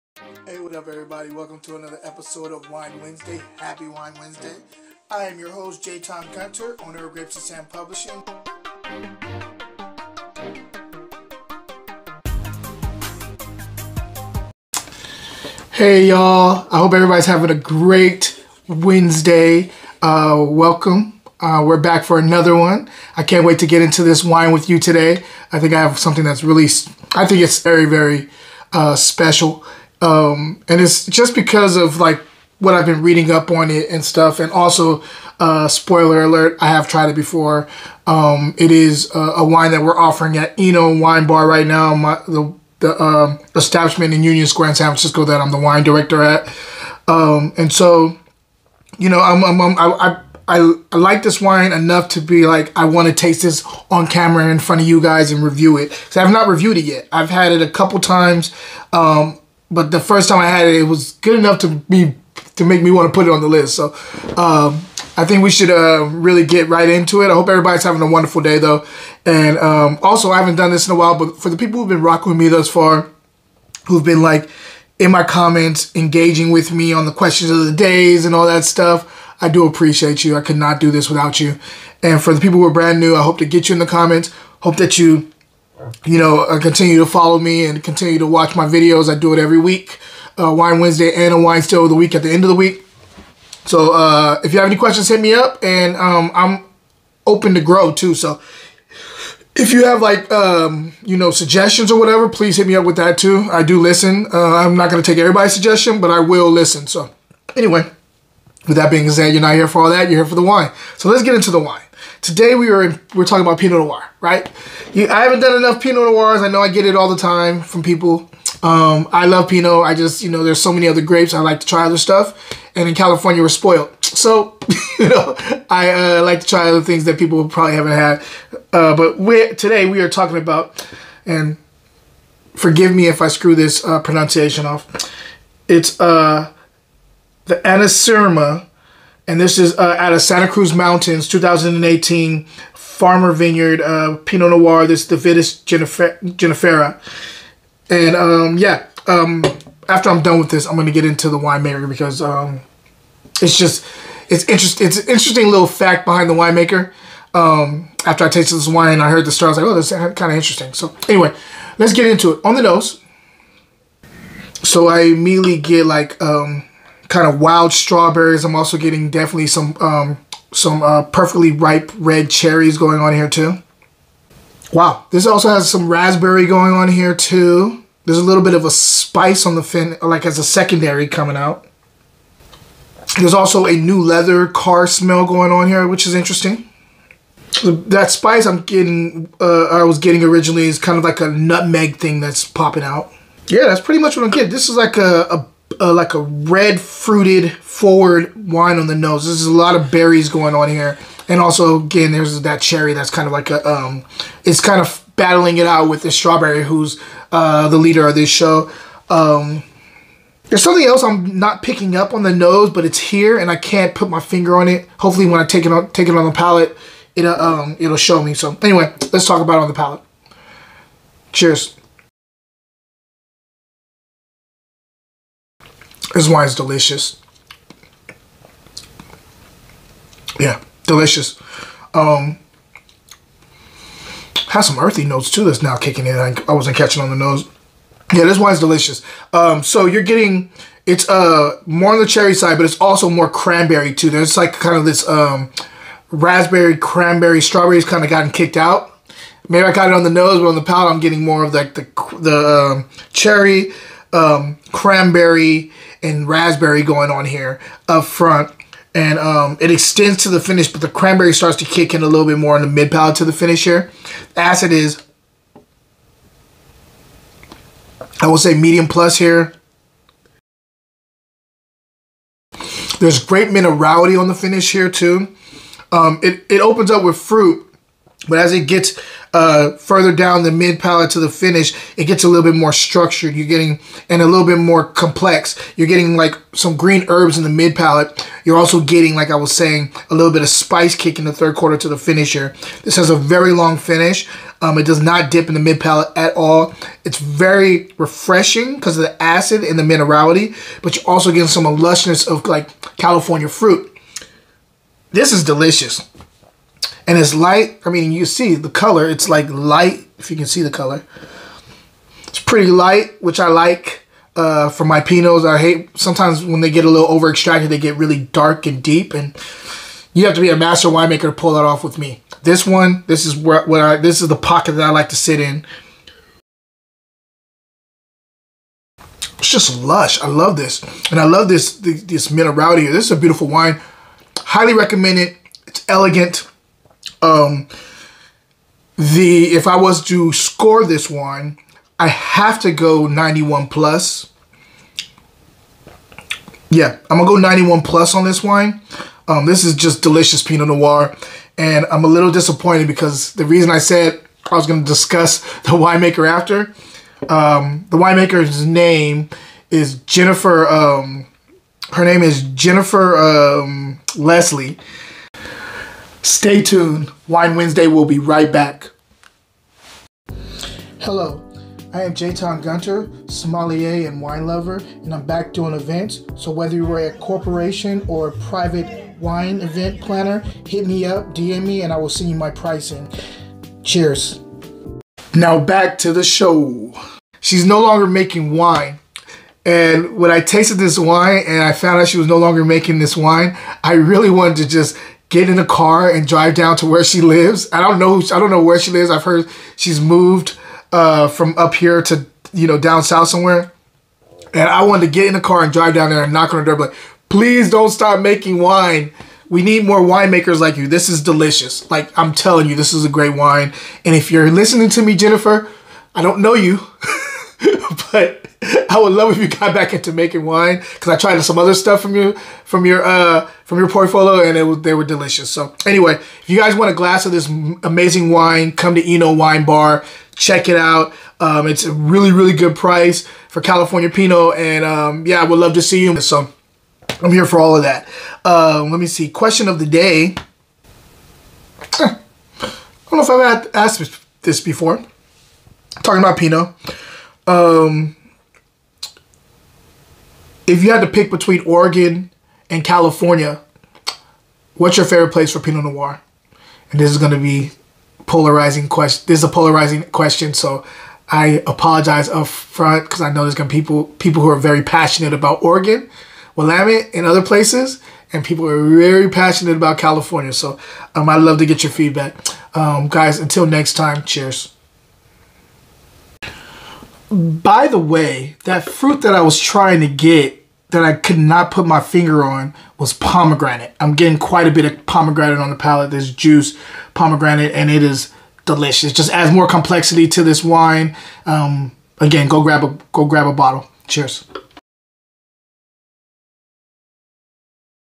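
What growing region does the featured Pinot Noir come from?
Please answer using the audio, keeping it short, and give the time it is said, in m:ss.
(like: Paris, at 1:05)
Santa Cruz Mountains, at 2:20.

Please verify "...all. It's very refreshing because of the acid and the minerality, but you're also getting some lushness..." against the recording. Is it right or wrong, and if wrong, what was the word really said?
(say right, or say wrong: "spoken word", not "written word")
right.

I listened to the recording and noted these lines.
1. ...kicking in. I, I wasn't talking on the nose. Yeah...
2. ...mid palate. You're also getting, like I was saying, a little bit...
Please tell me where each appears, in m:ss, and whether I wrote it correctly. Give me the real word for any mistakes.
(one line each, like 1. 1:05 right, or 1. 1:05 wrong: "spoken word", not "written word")
1. 3:55 wrong: "catching", not "talking"
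2. 4:47 right.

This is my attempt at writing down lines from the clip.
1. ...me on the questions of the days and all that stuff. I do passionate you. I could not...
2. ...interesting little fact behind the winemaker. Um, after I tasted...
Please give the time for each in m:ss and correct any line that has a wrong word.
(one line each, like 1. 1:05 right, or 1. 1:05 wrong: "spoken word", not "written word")
1. 1:16 wrong: "appreciate", not "passionate"
2. 2:35 right.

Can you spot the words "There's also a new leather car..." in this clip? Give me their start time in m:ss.
3:03.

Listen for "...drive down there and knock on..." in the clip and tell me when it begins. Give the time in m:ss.
6:45.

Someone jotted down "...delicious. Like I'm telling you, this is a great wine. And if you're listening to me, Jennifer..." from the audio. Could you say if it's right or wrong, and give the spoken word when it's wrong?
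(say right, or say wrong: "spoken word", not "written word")
right.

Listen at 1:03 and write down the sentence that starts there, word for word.
So um, I think we should uh, really get right into it.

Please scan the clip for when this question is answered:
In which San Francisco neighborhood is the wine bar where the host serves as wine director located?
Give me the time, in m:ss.
0:44.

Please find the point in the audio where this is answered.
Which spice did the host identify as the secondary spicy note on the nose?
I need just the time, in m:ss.
3:11.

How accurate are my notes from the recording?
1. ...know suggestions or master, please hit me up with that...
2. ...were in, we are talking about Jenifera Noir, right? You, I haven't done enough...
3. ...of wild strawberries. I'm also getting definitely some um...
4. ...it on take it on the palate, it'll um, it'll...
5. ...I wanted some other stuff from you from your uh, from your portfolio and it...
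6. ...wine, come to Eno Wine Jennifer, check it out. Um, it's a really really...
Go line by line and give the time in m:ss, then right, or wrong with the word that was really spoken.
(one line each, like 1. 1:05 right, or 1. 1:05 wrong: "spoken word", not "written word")
1. 1:41 wrong: "whatever", not "master"
2. 1:52 wrong: "Pinot", not "Jenifera"
3. 2:47 right
4. 3:35 right
5. 7:01 wrong: "tried", not "wanted"
6. 7:08 wrong: "Bar", not "Jennifer".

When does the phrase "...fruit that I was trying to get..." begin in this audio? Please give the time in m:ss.
7:58.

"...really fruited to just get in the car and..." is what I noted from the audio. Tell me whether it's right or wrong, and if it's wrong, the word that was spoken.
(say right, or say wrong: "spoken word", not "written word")
wrong: "wanted", not "fruited".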